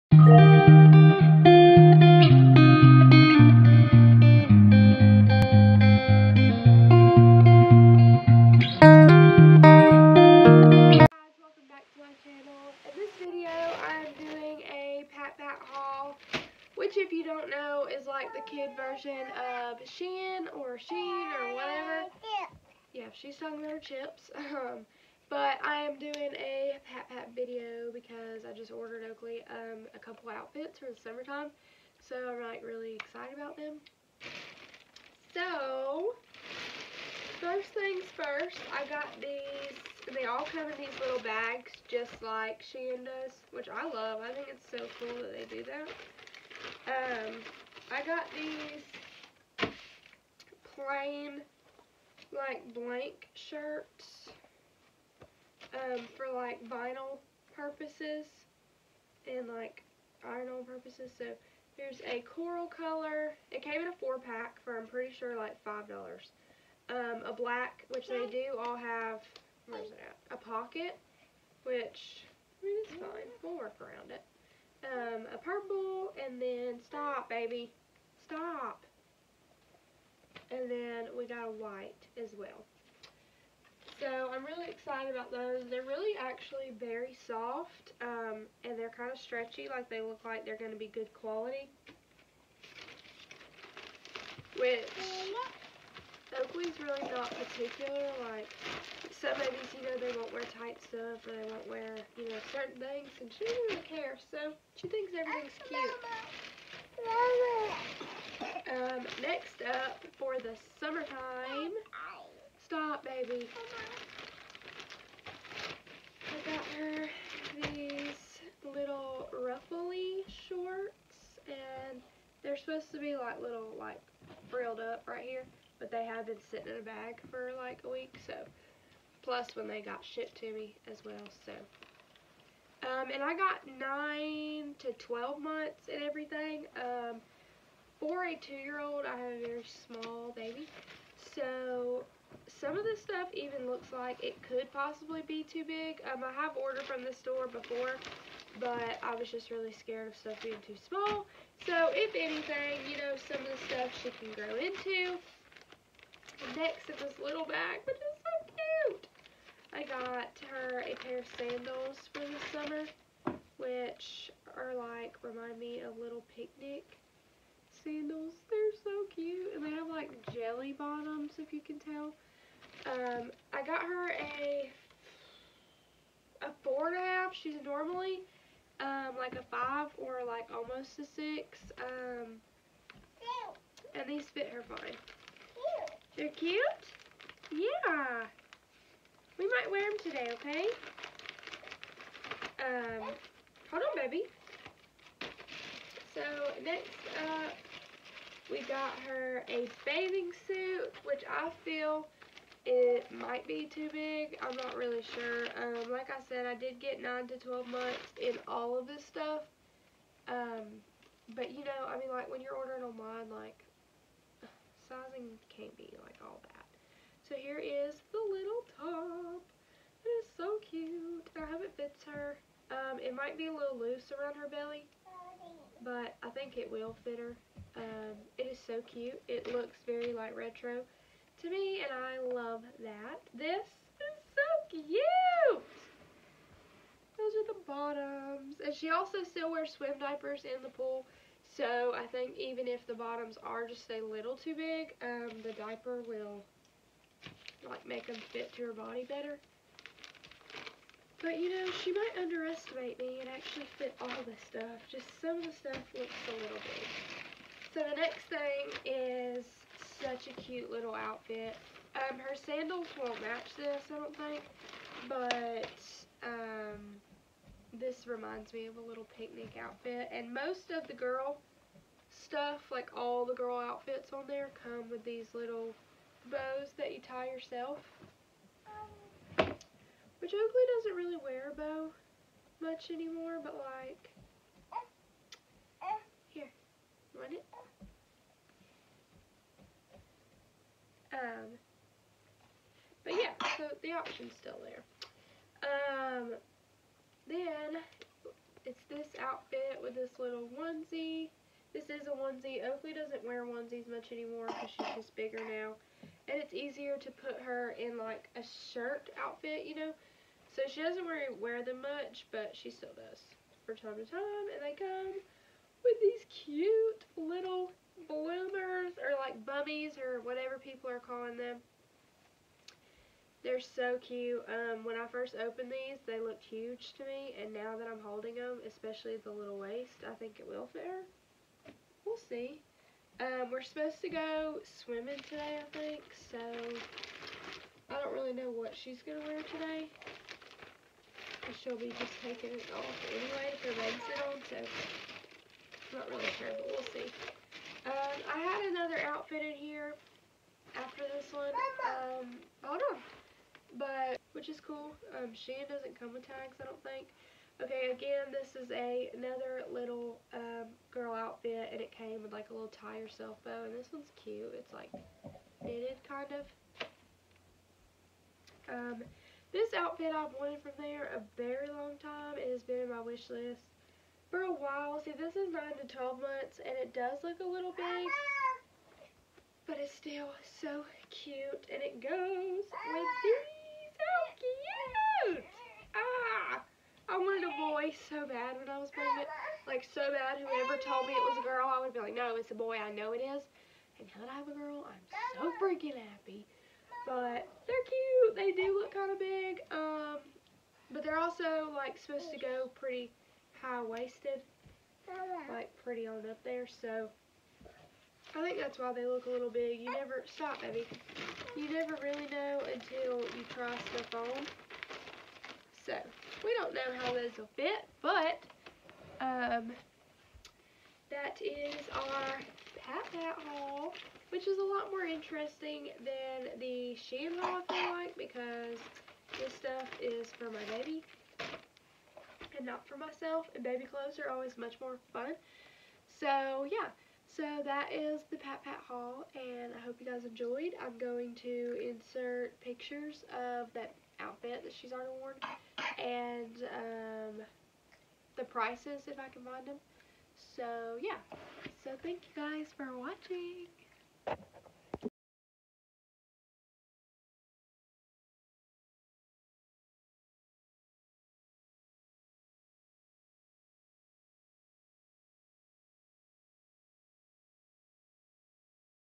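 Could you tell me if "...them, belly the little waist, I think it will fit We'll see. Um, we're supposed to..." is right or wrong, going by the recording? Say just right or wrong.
wrong.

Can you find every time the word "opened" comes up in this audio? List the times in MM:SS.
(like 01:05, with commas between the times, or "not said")
05:25.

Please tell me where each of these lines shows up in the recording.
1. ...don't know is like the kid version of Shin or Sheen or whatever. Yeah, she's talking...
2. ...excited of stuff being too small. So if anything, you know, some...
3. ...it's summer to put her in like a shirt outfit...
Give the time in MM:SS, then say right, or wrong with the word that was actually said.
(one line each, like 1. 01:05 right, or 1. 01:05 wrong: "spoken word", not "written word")
1. 00:17 right
2. 02:29 wrong: "scared", not "excited"
3. 05:06 wrong: "easier", not "summer".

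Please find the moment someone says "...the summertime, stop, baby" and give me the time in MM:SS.
01:50.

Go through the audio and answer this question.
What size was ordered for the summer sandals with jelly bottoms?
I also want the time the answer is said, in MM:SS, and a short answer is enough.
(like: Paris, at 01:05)
4.5, at 02:56.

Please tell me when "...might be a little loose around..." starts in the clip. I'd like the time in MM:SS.
03:43.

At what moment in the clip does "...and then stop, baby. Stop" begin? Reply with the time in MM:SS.
01:16.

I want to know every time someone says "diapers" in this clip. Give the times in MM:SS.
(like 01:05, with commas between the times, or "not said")
03:59, 04:05.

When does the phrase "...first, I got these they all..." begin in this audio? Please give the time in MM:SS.
00:38.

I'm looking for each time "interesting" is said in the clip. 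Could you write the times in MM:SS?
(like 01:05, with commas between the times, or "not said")
07:05.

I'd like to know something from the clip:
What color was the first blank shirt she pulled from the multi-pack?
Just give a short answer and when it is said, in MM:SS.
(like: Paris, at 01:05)
Coral, at 01:02.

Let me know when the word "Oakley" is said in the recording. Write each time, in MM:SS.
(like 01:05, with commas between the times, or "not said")
00:29, 01:36, 04:40, 05:02.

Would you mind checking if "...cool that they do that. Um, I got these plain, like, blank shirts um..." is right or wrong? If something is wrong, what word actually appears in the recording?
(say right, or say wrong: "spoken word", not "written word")
right.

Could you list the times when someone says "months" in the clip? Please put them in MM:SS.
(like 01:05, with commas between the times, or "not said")
02:15, 03:27, 06:16.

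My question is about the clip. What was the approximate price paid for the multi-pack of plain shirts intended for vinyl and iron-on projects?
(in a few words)
$5.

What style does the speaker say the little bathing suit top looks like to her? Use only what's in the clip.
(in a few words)
Retro.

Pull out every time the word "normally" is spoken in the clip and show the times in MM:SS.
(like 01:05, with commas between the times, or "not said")
02:57.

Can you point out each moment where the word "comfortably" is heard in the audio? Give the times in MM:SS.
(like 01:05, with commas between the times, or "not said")
not said.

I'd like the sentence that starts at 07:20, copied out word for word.
I'm going to insert pictures of that outfit that she's already worn and um, the prices if I can find them.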